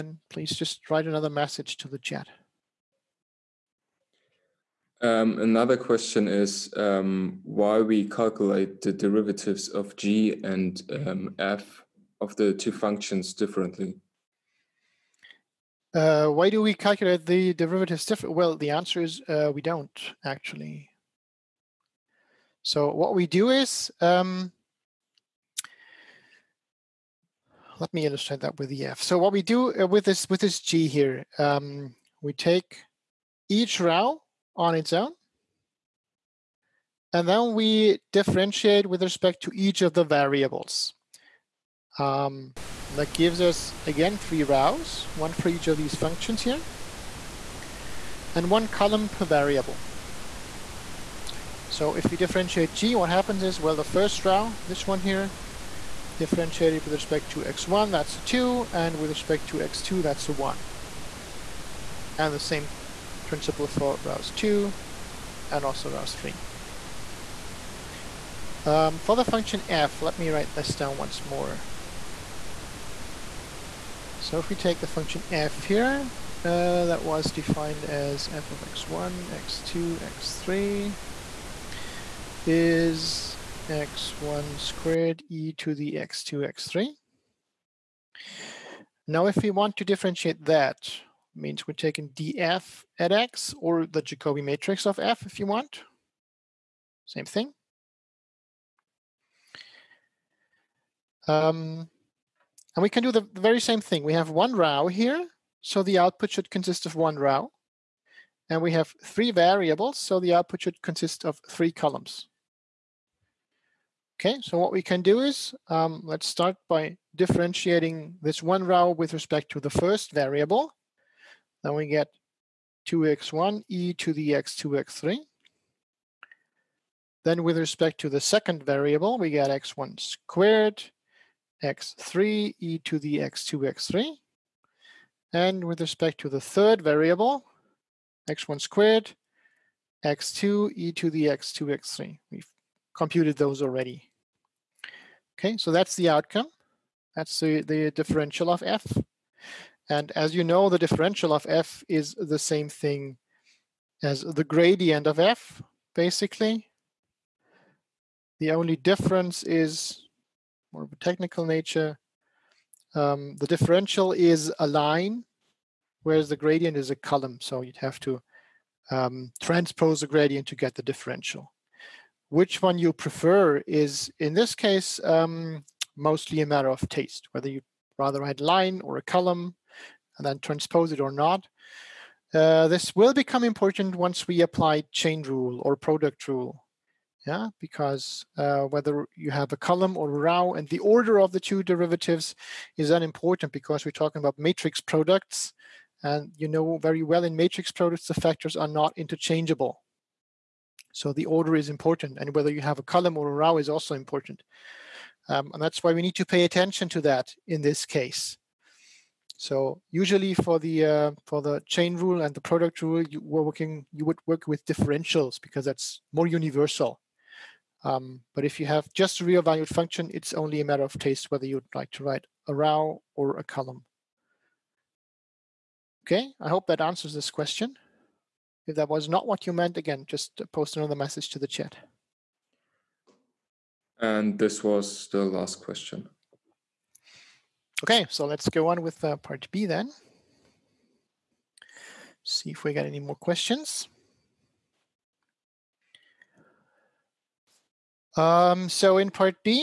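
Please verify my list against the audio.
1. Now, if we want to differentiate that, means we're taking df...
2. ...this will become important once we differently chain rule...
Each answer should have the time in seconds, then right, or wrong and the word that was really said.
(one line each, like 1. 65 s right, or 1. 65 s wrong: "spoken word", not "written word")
1. 89 s right
2. 182 s wrong: "apply", not "differently".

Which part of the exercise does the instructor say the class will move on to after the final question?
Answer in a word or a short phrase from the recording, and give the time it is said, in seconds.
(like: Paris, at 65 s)
part B, at 239 s.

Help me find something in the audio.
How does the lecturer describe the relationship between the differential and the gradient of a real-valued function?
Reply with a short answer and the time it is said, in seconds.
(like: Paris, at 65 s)
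the same thing, at 151 s.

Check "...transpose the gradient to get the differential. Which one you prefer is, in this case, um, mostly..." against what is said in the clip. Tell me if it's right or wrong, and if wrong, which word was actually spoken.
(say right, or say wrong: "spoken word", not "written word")
right.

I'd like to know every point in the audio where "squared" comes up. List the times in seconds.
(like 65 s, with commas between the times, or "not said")
84 s, 129 s, 138 s.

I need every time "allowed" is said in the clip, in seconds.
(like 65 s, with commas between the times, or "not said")
not said.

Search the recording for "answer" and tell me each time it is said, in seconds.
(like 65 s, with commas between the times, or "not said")
18 s, 226 s.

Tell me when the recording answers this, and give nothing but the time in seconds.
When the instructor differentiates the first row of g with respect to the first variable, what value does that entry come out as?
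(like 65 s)
57 s.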